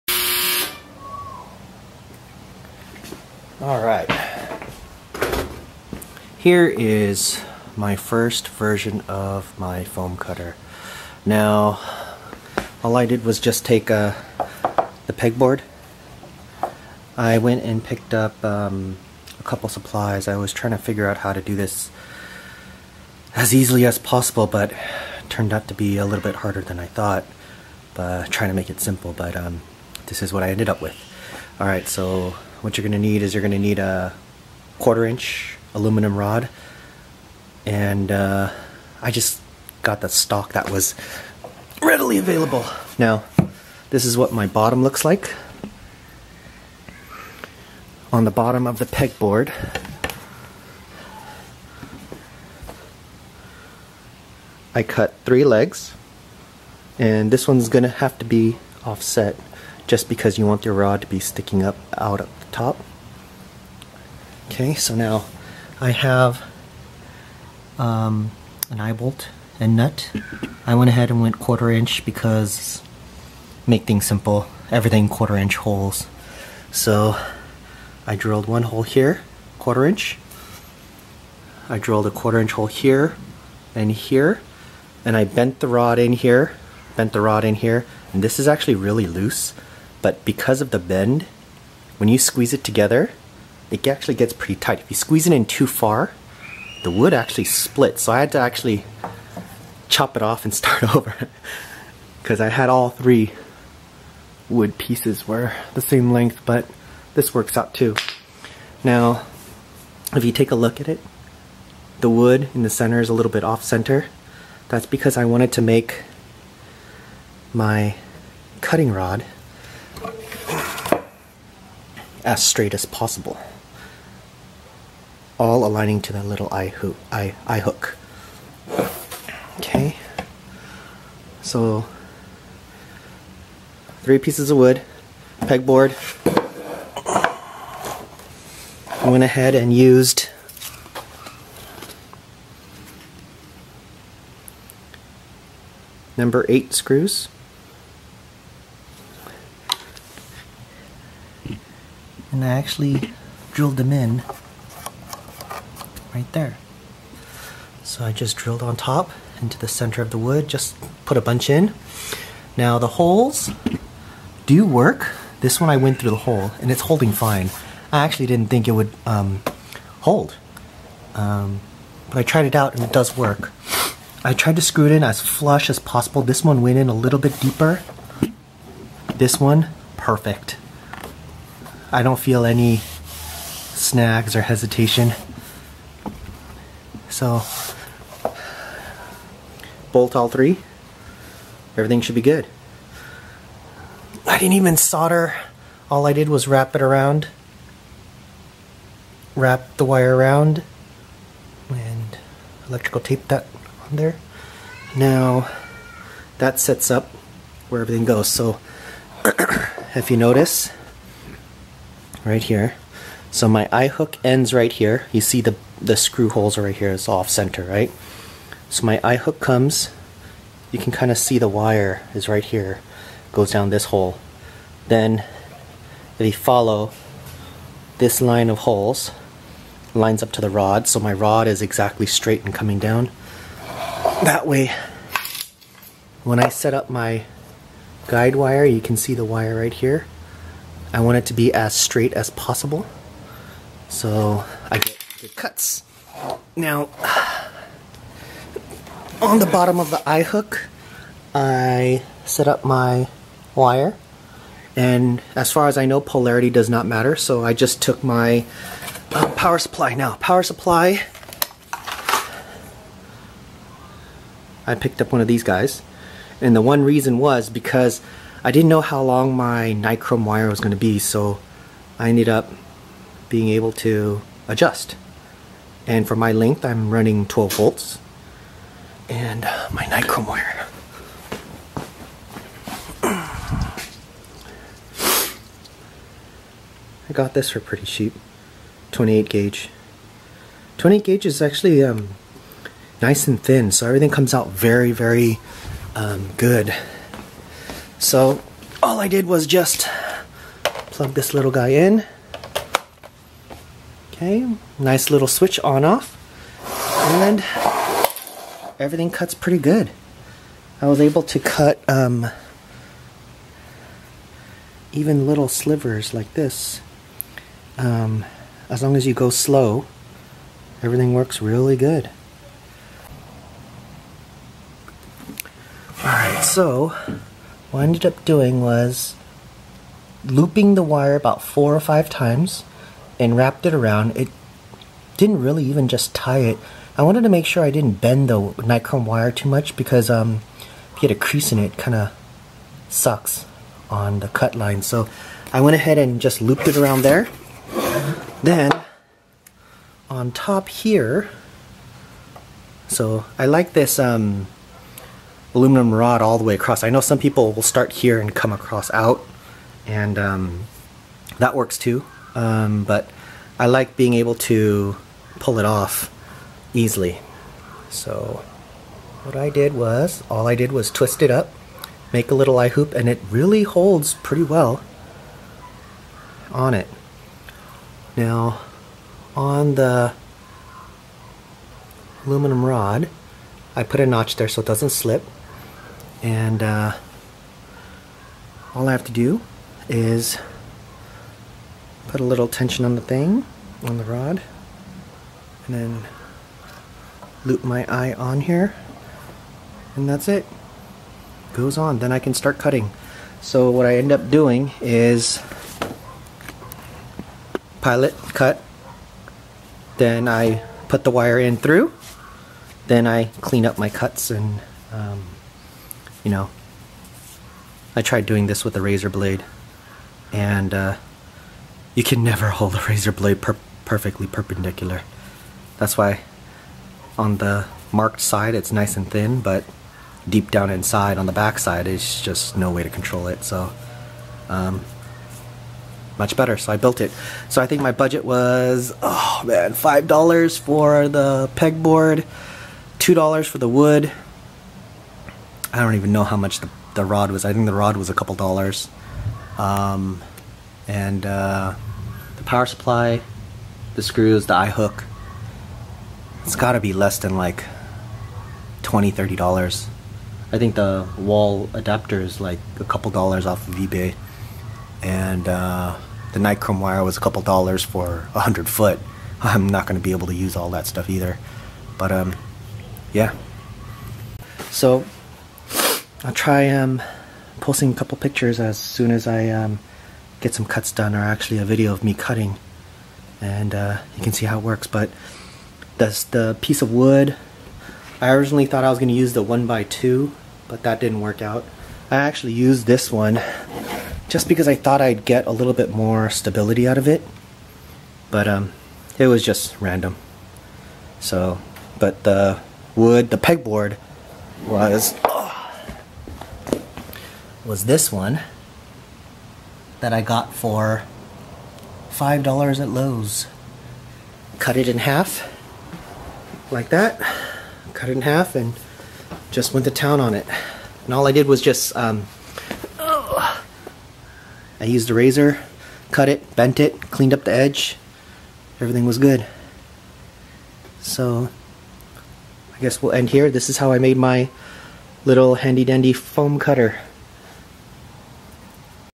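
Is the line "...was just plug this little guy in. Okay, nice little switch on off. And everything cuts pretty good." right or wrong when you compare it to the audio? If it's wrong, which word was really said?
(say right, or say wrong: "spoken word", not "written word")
right.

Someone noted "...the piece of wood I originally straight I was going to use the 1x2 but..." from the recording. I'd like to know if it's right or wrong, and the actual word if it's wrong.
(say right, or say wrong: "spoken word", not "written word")
wrong: "thought", not "straight".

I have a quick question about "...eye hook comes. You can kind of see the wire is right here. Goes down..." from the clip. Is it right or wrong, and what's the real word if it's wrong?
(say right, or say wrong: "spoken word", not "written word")
right.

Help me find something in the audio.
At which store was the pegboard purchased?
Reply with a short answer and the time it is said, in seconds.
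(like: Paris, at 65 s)
Lowe's, at 512 s.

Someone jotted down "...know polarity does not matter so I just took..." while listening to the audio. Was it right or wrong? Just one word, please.
right.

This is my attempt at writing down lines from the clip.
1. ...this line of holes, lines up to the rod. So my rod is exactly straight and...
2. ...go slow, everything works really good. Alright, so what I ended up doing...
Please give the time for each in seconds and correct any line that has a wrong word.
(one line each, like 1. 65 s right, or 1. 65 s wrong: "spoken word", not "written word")
1. 227 s right
2. 319 s right.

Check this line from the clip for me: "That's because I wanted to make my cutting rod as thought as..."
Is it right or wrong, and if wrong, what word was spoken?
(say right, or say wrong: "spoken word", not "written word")
wrong: "straight", not "thought".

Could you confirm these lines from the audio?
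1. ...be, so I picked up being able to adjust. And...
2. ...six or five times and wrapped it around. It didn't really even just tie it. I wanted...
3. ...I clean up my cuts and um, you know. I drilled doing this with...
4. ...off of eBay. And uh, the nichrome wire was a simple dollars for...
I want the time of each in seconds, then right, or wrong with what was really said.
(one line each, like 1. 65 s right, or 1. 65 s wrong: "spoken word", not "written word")
1. 270 s wrong: "ended", not "picked"
2. 331 s wrong: "four", not "six"
3. 413 s wrong: "tried", not "drilled"
4. 463 s wrong: "couple", not "simple".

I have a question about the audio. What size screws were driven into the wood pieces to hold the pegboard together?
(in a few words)
Number 8.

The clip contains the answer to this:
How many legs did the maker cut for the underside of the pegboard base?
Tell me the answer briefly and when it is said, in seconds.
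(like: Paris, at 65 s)
3, at 55 s.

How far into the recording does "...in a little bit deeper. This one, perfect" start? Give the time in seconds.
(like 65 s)
176 s.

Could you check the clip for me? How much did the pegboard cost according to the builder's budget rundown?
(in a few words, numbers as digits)
$5.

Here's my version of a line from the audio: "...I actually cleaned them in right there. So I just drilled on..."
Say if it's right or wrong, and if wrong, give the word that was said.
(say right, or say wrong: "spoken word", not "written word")
wrong: "drilled", not "cleaned".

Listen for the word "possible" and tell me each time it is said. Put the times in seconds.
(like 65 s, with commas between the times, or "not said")
23 s, 122 s, 175 s, 242 s.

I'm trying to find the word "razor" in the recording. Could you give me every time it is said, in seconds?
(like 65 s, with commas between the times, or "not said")
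418 s, 422 s, 525 s.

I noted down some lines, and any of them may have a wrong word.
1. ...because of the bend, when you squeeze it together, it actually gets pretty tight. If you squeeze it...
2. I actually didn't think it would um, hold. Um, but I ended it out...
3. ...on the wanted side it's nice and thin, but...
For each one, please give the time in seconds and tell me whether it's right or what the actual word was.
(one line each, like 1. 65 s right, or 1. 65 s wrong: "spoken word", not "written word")
1. 90 s right
2. 167 s wrong: "tried", not "ended"
3. 427 s wrong: "marked", not "wanted".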